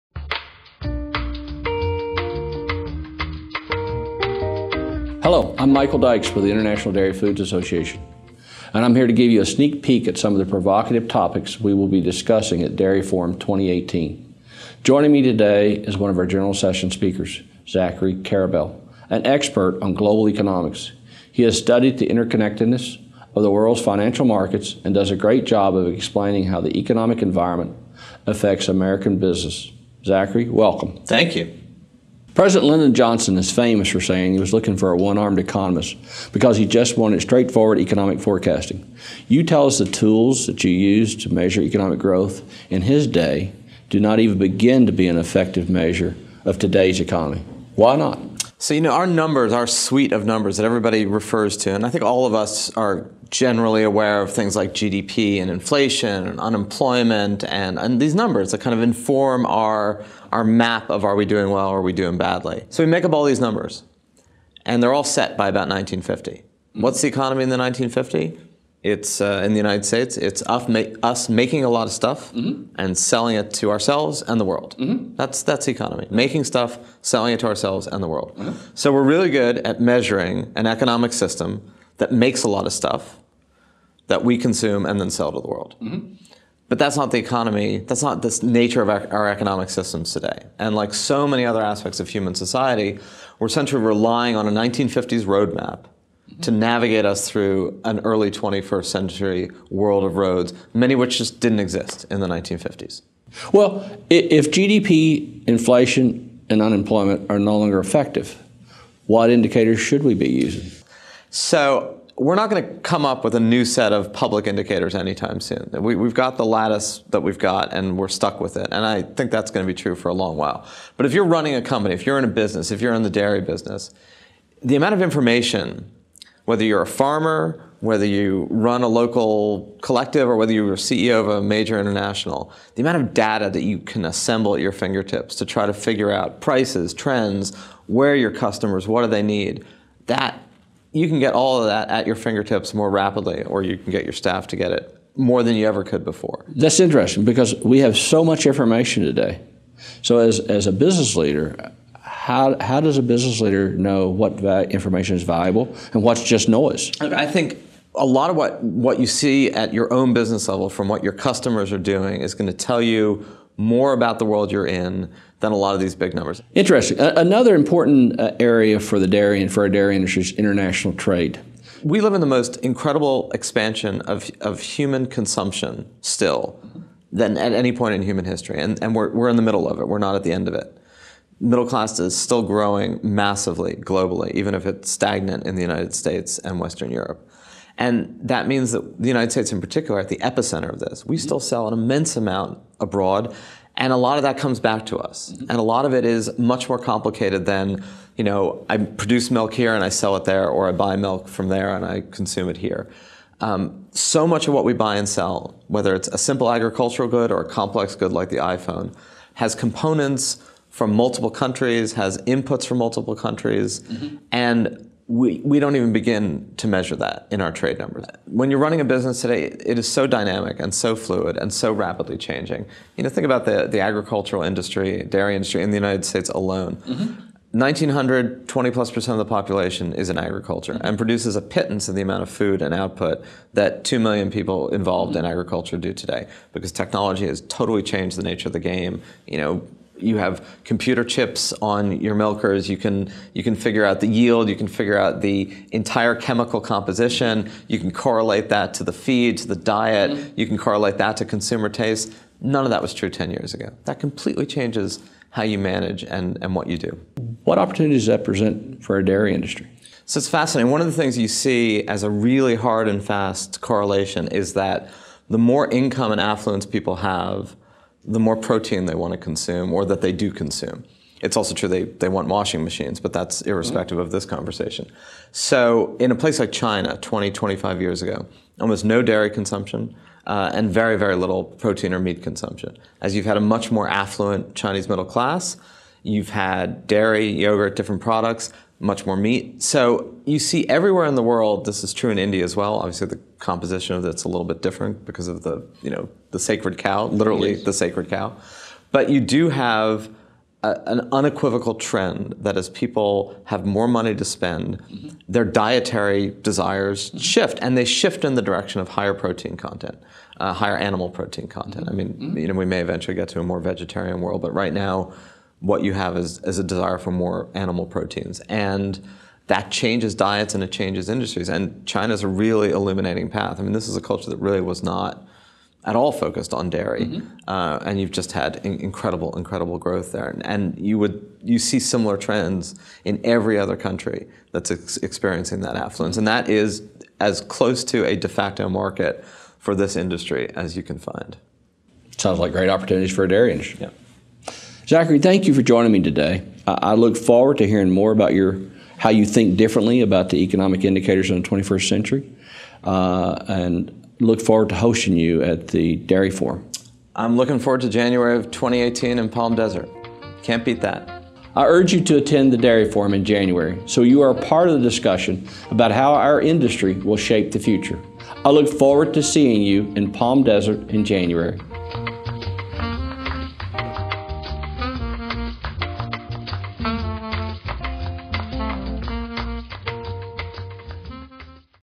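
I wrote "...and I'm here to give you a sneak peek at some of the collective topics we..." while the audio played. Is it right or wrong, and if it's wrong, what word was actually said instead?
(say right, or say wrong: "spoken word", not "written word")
wrong: "provocative", not "collective".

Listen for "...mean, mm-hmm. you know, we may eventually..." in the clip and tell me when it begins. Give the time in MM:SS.
05:11.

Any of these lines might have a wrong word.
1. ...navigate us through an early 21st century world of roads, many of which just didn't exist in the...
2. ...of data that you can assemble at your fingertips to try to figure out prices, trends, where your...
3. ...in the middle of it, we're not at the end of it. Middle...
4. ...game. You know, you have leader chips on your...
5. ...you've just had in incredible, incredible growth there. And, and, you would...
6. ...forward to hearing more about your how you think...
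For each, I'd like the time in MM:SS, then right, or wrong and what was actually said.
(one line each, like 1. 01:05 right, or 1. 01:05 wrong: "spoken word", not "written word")
1. 01:36 right
2. 02:13 right
3. 02:59 right
4. 03:58 wrong: "computer", not "leader"
5. 05:27 right
6. 05:47 right.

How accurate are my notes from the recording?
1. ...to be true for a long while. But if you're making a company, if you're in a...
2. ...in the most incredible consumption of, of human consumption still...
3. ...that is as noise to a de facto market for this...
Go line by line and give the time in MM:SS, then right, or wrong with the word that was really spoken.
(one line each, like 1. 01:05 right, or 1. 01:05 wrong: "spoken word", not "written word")
1. 01:59 wrong: "running", not "making"
2. 02:52 wrong: "expansion", not "consumption"
3. 05:36 wrong: "close", not "noise".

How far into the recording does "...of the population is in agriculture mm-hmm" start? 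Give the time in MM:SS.
03:49.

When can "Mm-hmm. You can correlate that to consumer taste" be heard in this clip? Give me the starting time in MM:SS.
04:10.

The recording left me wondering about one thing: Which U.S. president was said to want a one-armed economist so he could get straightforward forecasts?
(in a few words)
Lyndon Johnson.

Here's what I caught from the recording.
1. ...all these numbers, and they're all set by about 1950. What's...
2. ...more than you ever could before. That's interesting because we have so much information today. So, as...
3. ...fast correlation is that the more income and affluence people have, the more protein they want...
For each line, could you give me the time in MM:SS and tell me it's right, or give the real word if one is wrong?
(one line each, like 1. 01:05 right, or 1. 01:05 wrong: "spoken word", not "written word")
1. 01:03 right
2. 02:25 right
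3. 04:23 right.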